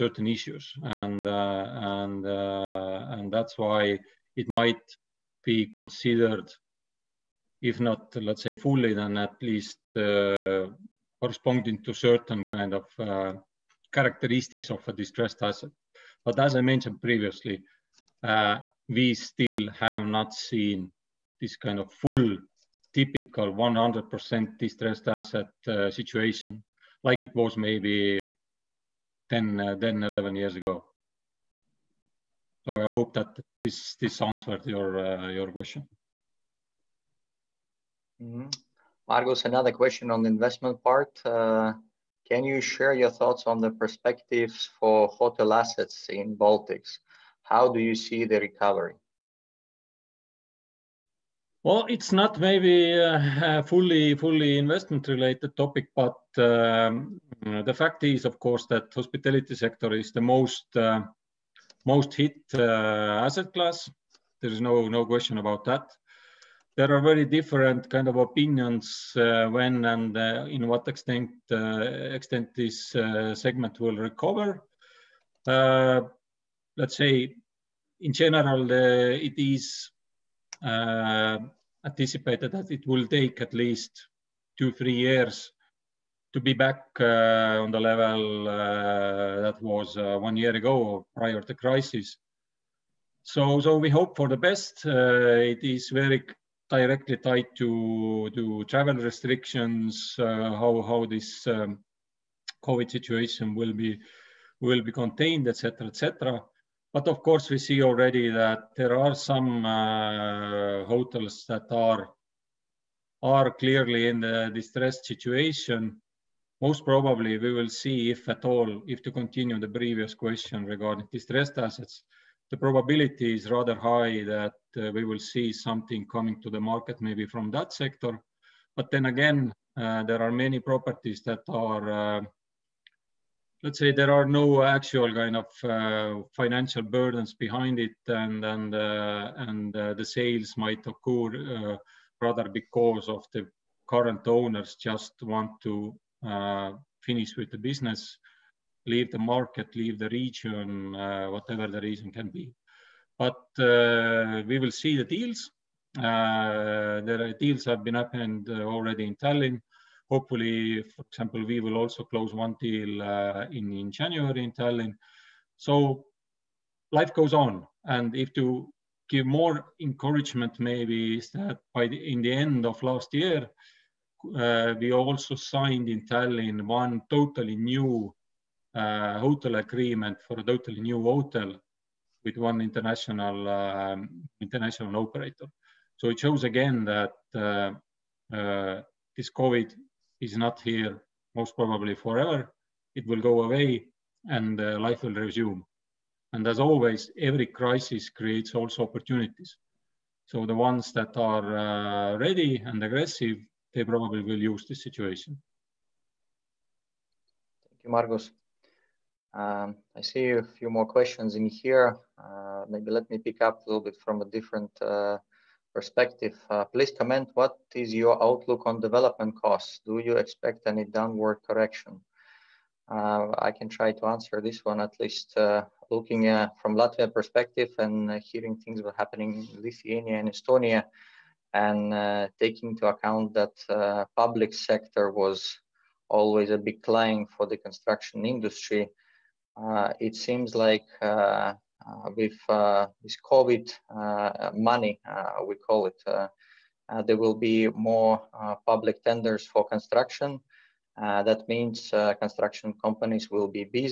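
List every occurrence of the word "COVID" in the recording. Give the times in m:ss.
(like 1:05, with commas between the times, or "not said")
1:42, 3:09, 4:03.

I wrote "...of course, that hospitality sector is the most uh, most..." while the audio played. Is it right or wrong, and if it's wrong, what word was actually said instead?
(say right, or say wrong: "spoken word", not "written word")
right.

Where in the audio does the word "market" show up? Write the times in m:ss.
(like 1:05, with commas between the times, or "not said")
2:06, 2:29.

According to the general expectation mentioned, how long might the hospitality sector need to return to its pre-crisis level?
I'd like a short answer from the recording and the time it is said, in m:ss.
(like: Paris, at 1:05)
2 to 3 years, at 1:24.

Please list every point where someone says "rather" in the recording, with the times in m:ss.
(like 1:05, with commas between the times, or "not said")
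2:03, 2:22.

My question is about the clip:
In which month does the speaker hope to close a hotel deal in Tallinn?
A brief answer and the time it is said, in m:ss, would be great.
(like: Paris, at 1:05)
January, at 2:43.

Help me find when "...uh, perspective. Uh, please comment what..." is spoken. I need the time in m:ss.
3:34.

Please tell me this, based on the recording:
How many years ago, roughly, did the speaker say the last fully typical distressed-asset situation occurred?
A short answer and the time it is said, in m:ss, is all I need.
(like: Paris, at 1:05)
10 to 11 years, at 0:29.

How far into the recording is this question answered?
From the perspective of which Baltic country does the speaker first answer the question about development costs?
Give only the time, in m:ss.
3:46.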